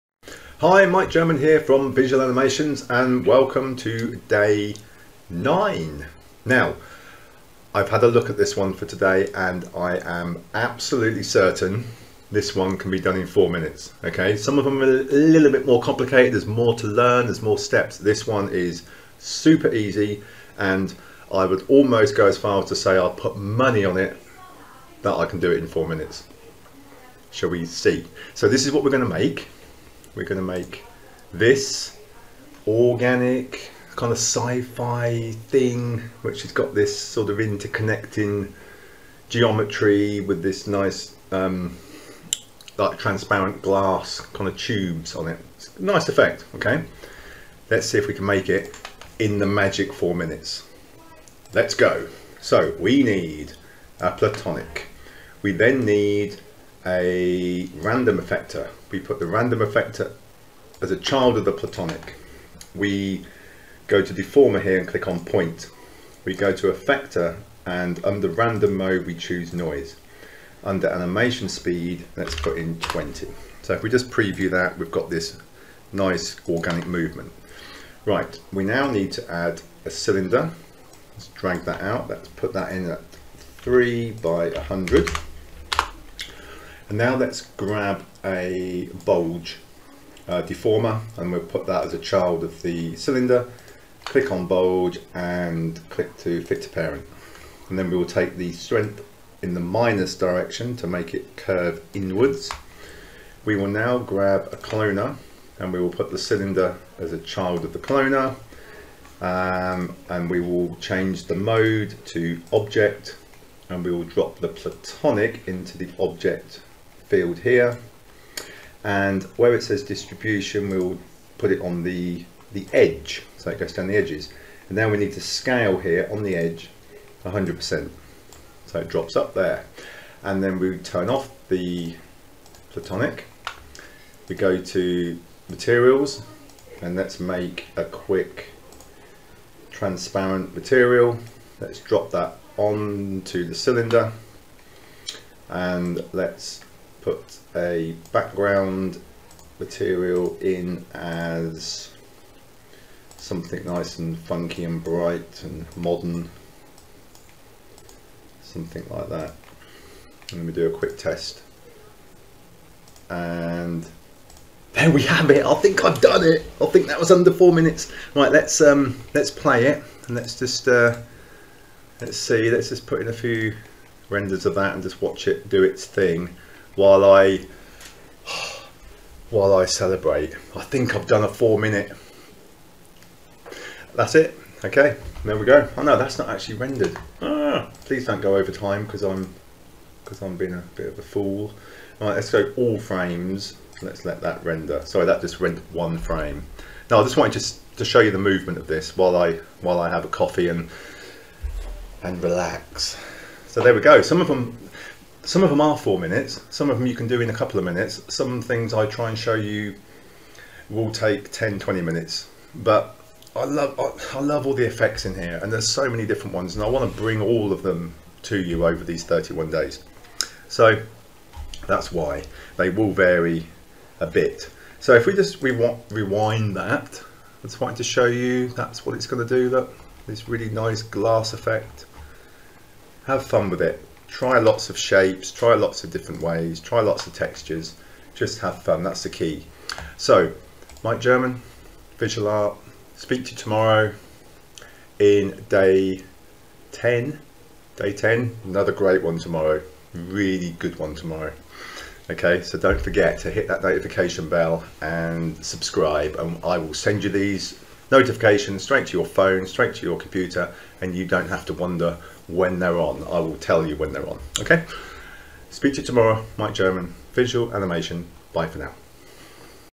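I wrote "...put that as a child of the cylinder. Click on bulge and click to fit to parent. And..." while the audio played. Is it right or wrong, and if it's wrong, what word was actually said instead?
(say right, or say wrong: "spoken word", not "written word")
right.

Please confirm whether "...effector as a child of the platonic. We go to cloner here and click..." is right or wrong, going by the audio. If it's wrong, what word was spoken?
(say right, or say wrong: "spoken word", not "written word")
wrong: "deformer", not "cloner".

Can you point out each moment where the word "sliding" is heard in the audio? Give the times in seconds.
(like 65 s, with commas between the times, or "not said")
not said.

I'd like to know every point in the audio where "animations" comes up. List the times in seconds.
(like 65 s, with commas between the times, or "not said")
2 s, 70 s, 267 s.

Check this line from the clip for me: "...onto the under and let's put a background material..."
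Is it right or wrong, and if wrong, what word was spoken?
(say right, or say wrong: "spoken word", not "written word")
wrong: "cylinder", not "under".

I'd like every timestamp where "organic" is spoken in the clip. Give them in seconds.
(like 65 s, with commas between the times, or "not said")
32 s, 76 s.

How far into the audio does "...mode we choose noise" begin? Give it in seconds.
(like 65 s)
68 s.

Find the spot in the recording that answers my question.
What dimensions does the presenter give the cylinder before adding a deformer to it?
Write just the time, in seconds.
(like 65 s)
83 s.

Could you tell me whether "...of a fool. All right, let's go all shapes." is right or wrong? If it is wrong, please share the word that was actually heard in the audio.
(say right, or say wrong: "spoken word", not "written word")
wrong: "frames", not "shapes".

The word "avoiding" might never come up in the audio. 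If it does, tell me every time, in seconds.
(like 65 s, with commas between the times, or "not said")
not said.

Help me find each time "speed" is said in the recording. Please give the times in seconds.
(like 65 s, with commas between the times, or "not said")
71 s.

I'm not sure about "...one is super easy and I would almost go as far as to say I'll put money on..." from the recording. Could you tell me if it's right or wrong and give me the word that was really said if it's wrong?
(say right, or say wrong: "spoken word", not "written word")
right.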